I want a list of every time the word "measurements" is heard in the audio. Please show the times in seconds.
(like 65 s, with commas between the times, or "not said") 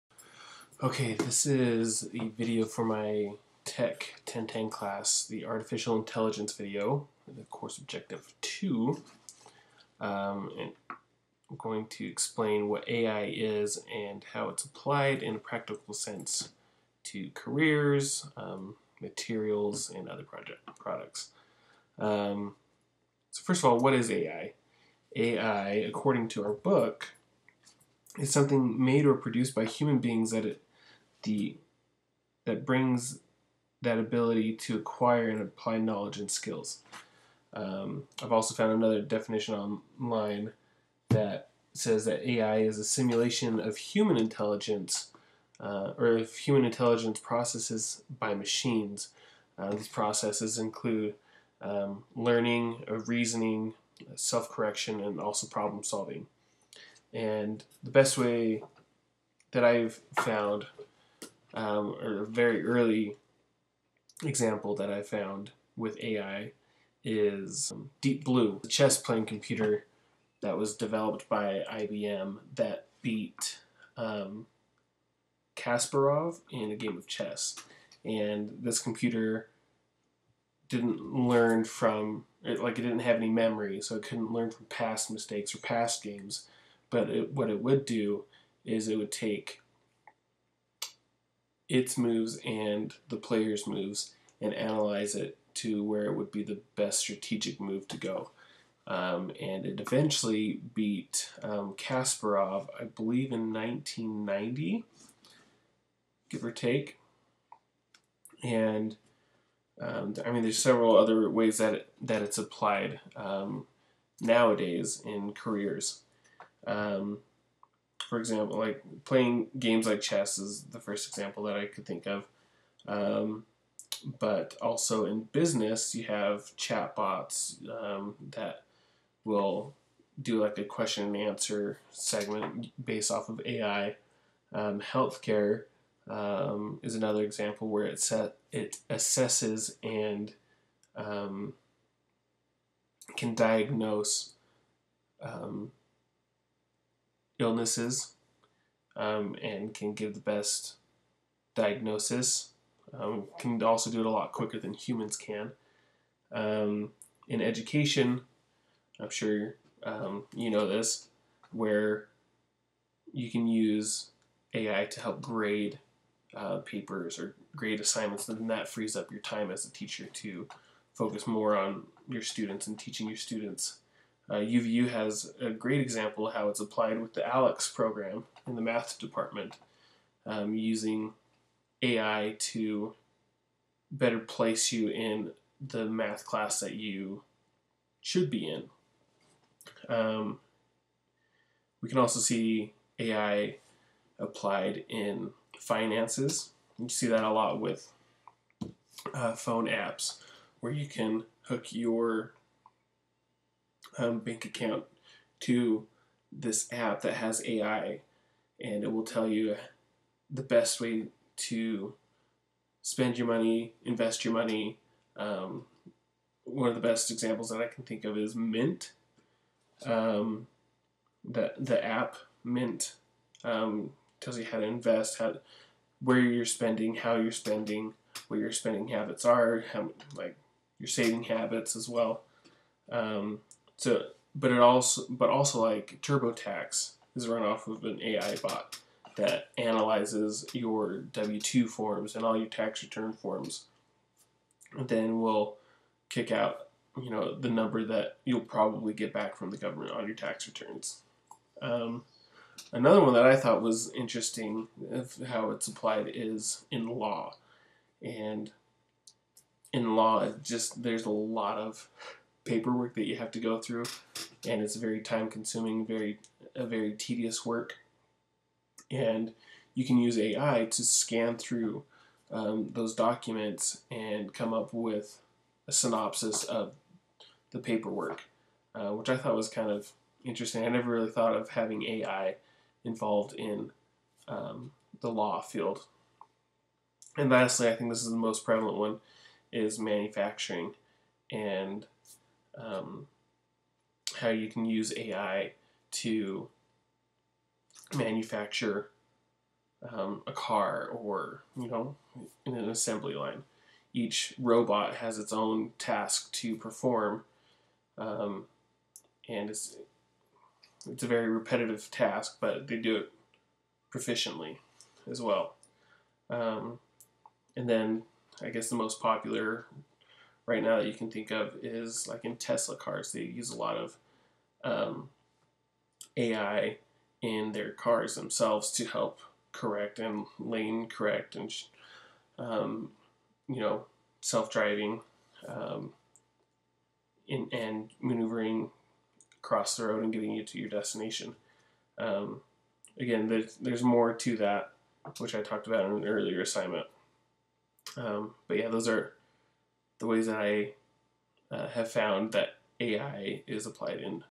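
not said.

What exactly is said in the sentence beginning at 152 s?
Um, can also do it a lot quicker than humans can.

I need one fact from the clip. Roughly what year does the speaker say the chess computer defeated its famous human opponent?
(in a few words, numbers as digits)
1990.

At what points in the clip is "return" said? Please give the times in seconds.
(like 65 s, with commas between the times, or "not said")
242 s, 250 s.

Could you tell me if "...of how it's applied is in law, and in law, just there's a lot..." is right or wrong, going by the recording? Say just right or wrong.
right.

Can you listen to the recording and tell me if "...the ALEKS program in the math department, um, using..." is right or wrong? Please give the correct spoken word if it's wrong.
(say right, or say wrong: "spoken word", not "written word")
right.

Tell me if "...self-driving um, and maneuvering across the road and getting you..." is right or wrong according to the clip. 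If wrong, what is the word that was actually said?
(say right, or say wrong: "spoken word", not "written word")
right.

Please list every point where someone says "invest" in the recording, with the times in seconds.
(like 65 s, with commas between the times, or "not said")
213 s, 224 s.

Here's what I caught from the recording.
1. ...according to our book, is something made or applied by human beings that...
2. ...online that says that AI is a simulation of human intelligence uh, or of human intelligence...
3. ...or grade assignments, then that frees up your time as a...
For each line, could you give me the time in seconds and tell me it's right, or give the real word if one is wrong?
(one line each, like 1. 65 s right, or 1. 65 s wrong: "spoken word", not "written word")
1. 25 s wrong: "produced", not "applied"
2. 39 s right
3. 167 s right.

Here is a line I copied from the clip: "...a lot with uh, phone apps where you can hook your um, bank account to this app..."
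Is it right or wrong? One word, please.
right.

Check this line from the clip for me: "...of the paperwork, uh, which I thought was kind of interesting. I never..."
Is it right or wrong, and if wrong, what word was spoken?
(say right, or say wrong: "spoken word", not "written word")
right.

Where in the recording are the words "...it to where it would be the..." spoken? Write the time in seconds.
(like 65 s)
95 s.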